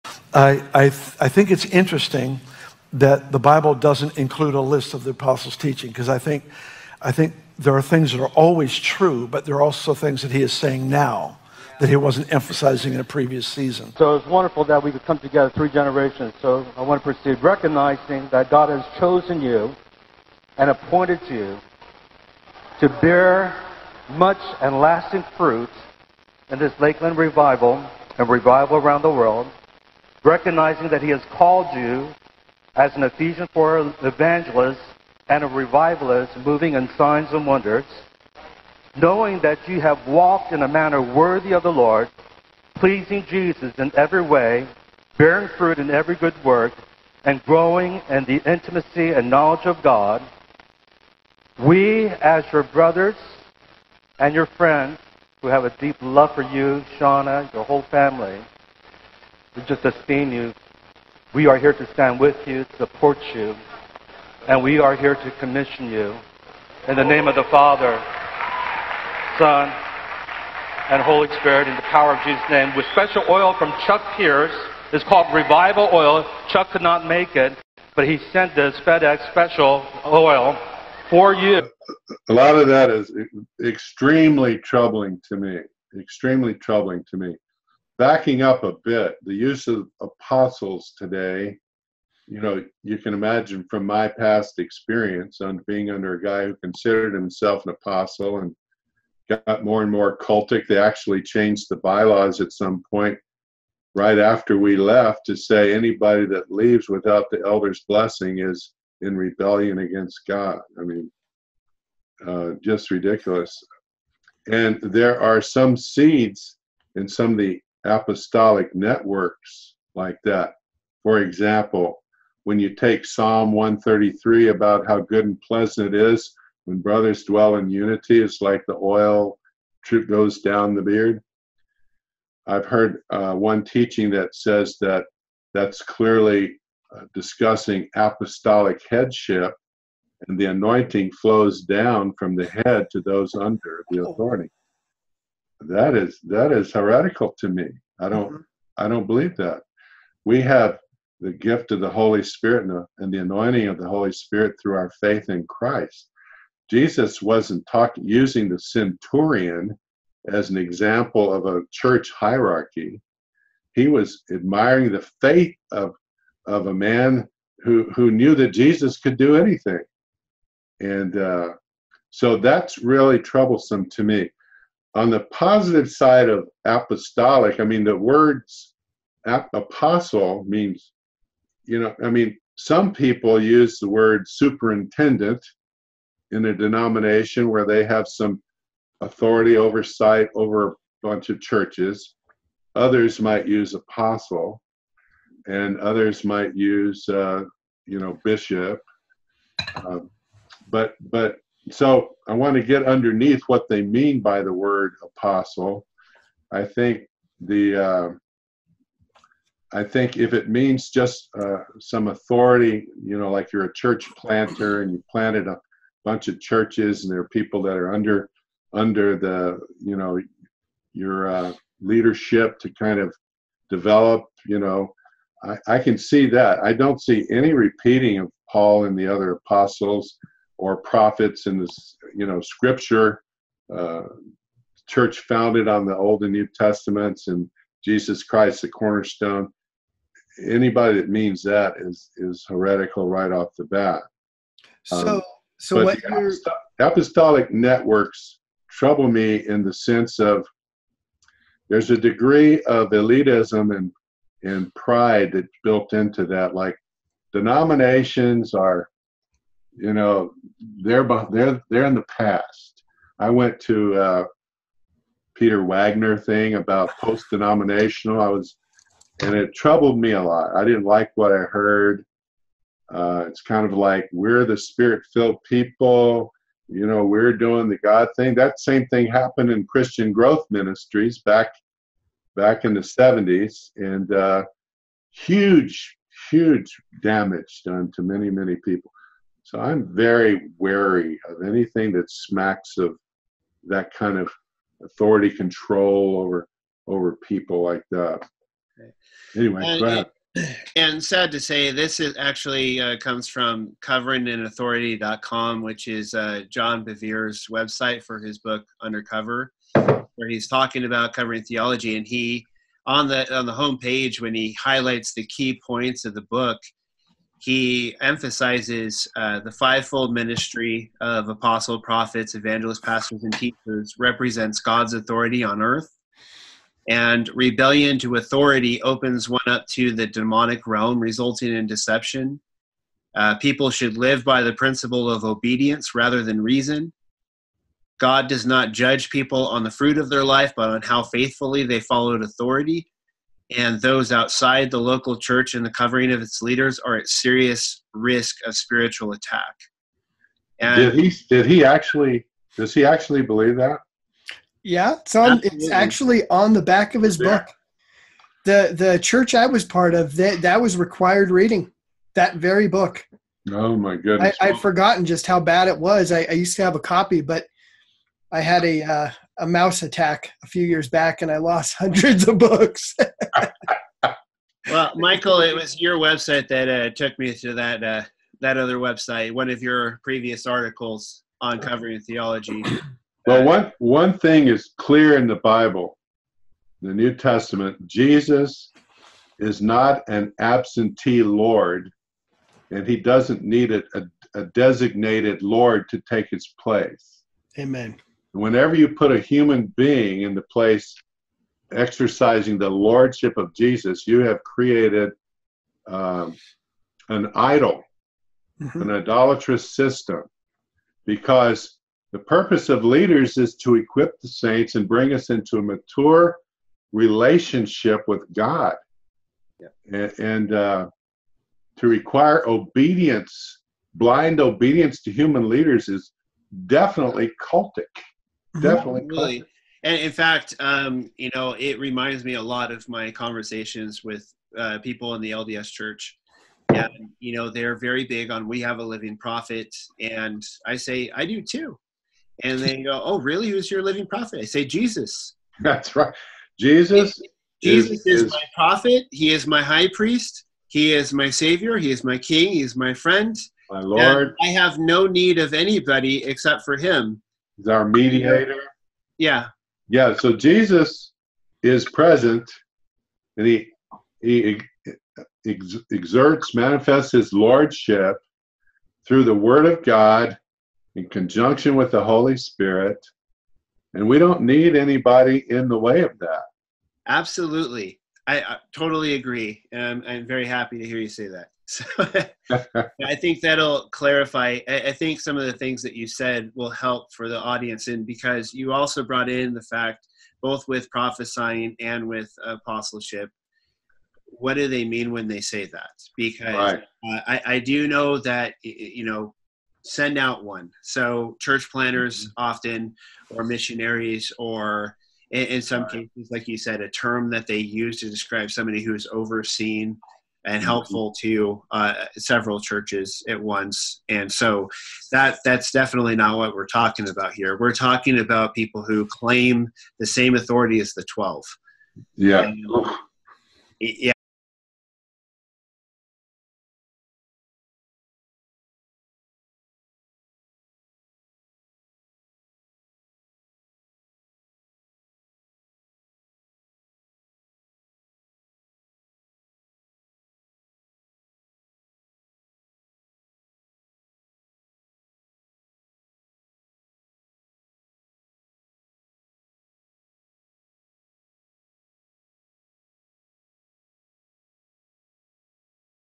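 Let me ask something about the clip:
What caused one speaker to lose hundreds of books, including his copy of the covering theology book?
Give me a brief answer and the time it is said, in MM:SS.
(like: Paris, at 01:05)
A mouse attack, at 06:09.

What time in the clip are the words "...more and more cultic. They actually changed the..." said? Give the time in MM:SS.
01:39.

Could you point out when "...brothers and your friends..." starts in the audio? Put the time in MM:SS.
00:52.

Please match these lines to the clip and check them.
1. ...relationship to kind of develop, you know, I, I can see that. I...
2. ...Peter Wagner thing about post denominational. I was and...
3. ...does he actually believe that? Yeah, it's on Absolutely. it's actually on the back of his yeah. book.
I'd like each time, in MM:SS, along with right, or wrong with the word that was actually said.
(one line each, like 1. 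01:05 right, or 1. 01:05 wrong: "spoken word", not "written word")
1. 03:41 wrong: "leadership", not "relationship"
2. 04:25 right
3. 05:52 right.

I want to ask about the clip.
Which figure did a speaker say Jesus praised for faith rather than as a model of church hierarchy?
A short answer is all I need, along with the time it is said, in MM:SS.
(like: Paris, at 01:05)
The centurion, at 02:38.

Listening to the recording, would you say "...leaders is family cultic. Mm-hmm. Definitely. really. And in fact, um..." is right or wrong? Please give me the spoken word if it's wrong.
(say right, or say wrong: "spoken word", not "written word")
wrong: "definitely", not "family".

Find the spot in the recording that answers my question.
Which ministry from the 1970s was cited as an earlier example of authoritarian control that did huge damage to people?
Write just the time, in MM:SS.
04:39.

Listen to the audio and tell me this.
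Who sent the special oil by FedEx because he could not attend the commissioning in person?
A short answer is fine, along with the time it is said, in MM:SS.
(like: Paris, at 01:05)
Chuck Pierce, at 01:13.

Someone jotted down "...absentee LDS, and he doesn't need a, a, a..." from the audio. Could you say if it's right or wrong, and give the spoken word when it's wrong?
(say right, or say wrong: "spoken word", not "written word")
wrong: "Lord", not "LDS".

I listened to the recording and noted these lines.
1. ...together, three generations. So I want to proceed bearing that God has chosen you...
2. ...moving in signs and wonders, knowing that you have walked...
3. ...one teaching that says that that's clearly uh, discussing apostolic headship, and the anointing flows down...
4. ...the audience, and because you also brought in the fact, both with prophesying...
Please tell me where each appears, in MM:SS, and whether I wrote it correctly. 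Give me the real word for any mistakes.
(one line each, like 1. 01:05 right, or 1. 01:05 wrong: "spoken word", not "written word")
1. 00:15 wrong: "recognizing", not "bearing"
2. 00:36 right
3. 02:13 right
4. 08:07 right.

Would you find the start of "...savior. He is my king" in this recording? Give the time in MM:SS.
07:31.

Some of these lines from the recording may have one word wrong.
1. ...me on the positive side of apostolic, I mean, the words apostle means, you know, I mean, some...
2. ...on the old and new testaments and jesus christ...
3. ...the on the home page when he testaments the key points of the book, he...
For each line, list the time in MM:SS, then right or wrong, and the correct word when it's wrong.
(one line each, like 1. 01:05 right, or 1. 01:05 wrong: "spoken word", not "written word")
1. 02:54 right
2. 03:55 right
3. 05:13 wrong: "highlights", not "testaments".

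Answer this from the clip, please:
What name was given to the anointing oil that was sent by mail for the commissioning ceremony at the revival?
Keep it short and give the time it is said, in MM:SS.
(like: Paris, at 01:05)
Revival Oil, at 01:15.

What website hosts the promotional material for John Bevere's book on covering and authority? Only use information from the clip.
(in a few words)
CoveringInAuthority.com.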